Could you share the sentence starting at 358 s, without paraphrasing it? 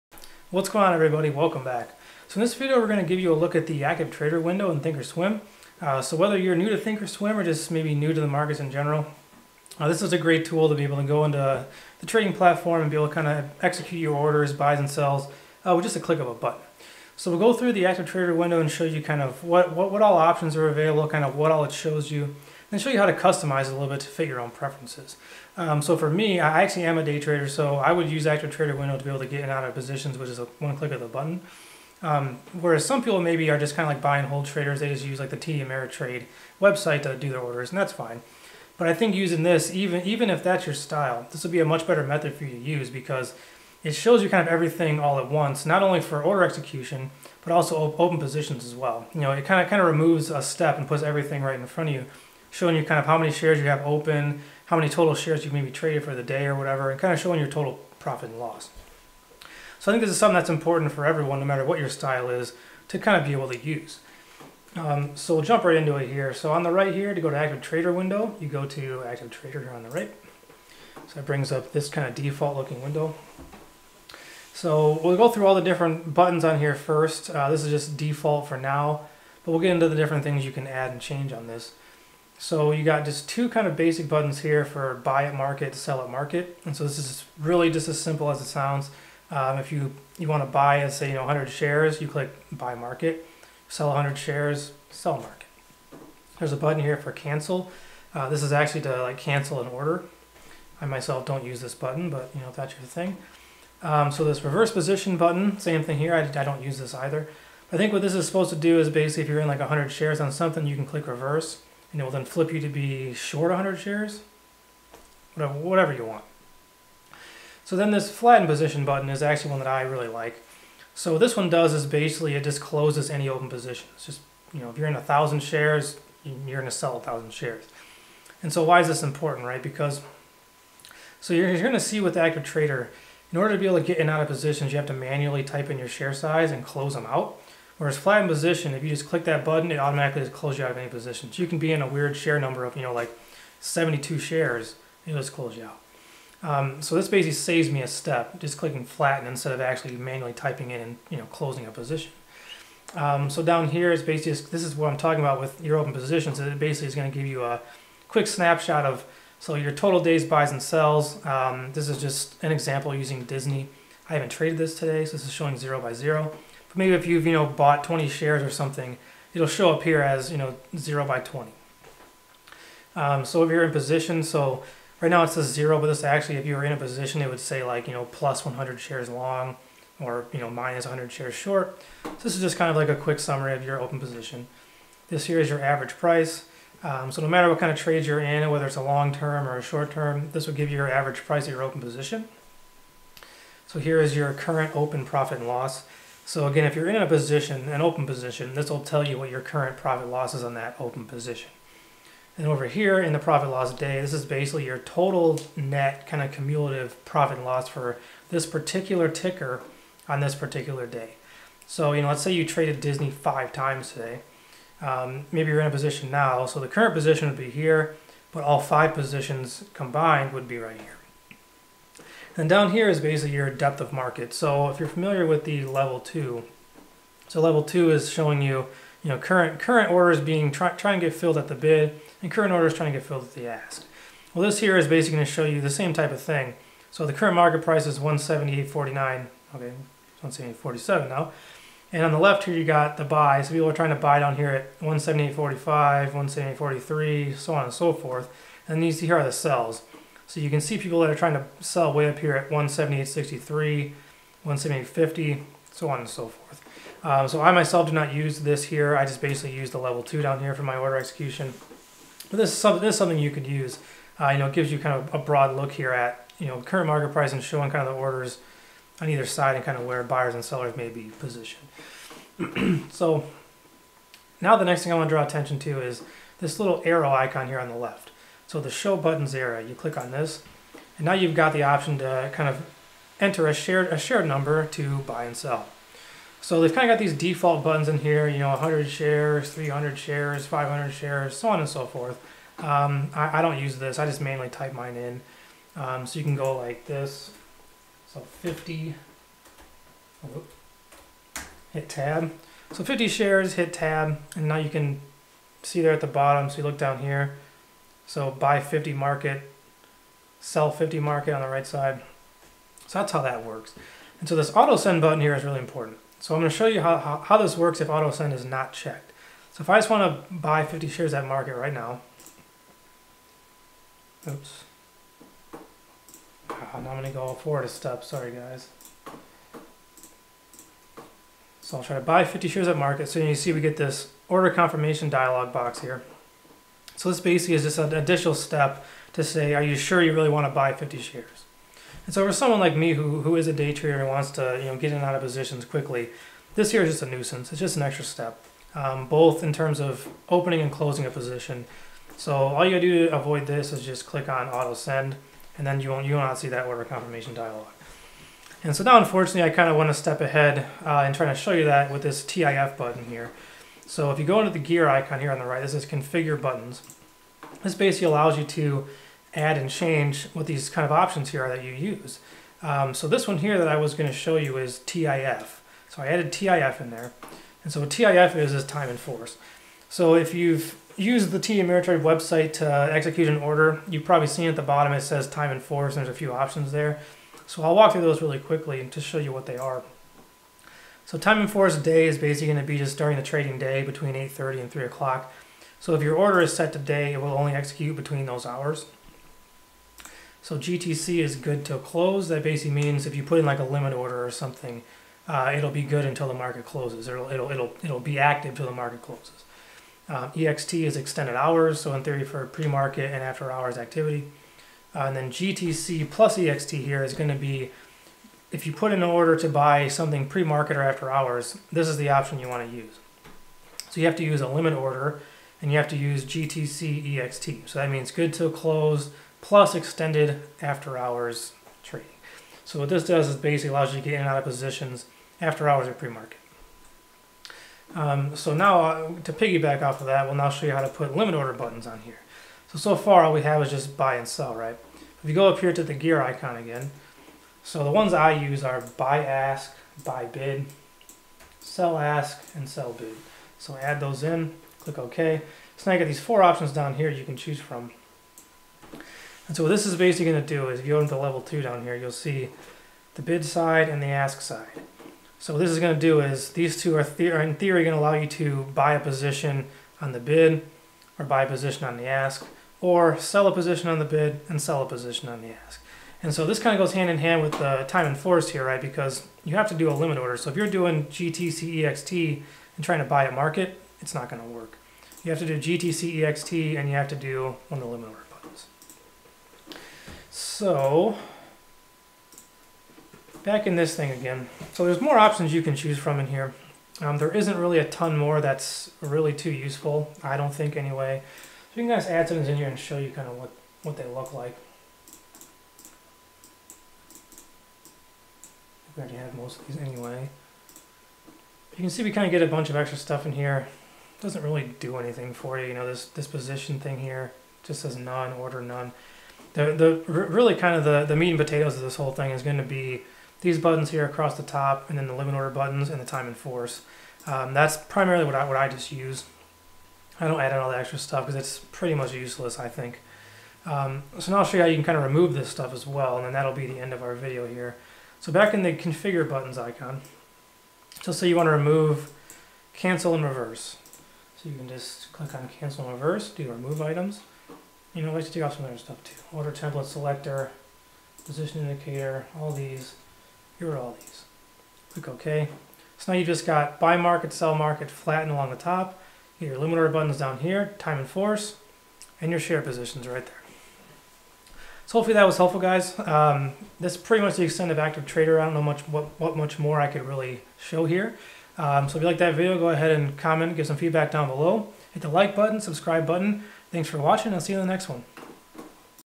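And so now, unfortunately, I kind of want to step ahead uh, try to show you that with this TIF button here.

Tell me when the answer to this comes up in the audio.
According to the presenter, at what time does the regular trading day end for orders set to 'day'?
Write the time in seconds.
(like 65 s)
394 s.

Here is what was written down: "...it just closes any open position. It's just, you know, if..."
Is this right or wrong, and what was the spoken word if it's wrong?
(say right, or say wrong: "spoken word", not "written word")
right.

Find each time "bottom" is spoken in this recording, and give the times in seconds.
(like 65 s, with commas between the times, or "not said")
306 s, 384 s.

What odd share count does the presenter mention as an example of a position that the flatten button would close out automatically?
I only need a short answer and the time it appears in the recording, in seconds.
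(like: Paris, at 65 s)
72, at 143 s.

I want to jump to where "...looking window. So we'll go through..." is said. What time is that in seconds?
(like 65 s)
72 s.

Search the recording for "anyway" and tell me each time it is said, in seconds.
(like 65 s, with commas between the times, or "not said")
500 s, 509 s.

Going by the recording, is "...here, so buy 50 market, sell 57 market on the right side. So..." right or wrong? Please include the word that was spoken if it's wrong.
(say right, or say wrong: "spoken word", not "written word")
wrong: "50", not "57".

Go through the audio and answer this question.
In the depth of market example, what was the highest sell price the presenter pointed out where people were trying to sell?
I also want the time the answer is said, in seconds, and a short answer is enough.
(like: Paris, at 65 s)
178.63, at 252 s.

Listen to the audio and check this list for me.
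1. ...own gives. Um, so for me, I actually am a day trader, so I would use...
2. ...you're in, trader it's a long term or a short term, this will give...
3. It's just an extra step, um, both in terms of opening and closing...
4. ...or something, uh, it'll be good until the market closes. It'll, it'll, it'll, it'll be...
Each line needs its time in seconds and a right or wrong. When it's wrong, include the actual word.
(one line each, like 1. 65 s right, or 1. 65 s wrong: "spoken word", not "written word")
1. 24 s wrong: "preferences", not "gives"
2. 188 s wrong: "whether", not "trader"
3. 347 s right
4. 404 s right.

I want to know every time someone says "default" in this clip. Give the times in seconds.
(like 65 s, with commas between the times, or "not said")
72 s, 77 s, 287 s.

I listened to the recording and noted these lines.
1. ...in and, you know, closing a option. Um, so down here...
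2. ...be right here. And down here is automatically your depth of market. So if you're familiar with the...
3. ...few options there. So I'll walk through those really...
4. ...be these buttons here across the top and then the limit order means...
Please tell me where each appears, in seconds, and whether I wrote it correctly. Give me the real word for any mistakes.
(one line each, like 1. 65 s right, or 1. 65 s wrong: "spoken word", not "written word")
1. 150 s wrong: "position", not "option"
2. 220 s wrong: "basically", not "automatically"
3. 386 s right
4. 522 s wrong: "buttons", not "means".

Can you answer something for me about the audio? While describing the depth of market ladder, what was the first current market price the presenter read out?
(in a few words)
178.49.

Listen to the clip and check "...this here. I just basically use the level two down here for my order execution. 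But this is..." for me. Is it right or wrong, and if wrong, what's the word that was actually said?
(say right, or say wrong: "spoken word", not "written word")
right.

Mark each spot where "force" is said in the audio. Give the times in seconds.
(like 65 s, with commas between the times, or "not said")
378 s, 385 s, 391 s, 478 s, 526 s, 561 s.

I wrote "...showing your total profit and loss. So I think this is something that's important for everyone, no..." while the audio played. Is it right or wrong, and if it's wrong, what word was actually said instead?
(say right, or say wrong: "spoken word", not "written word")
right.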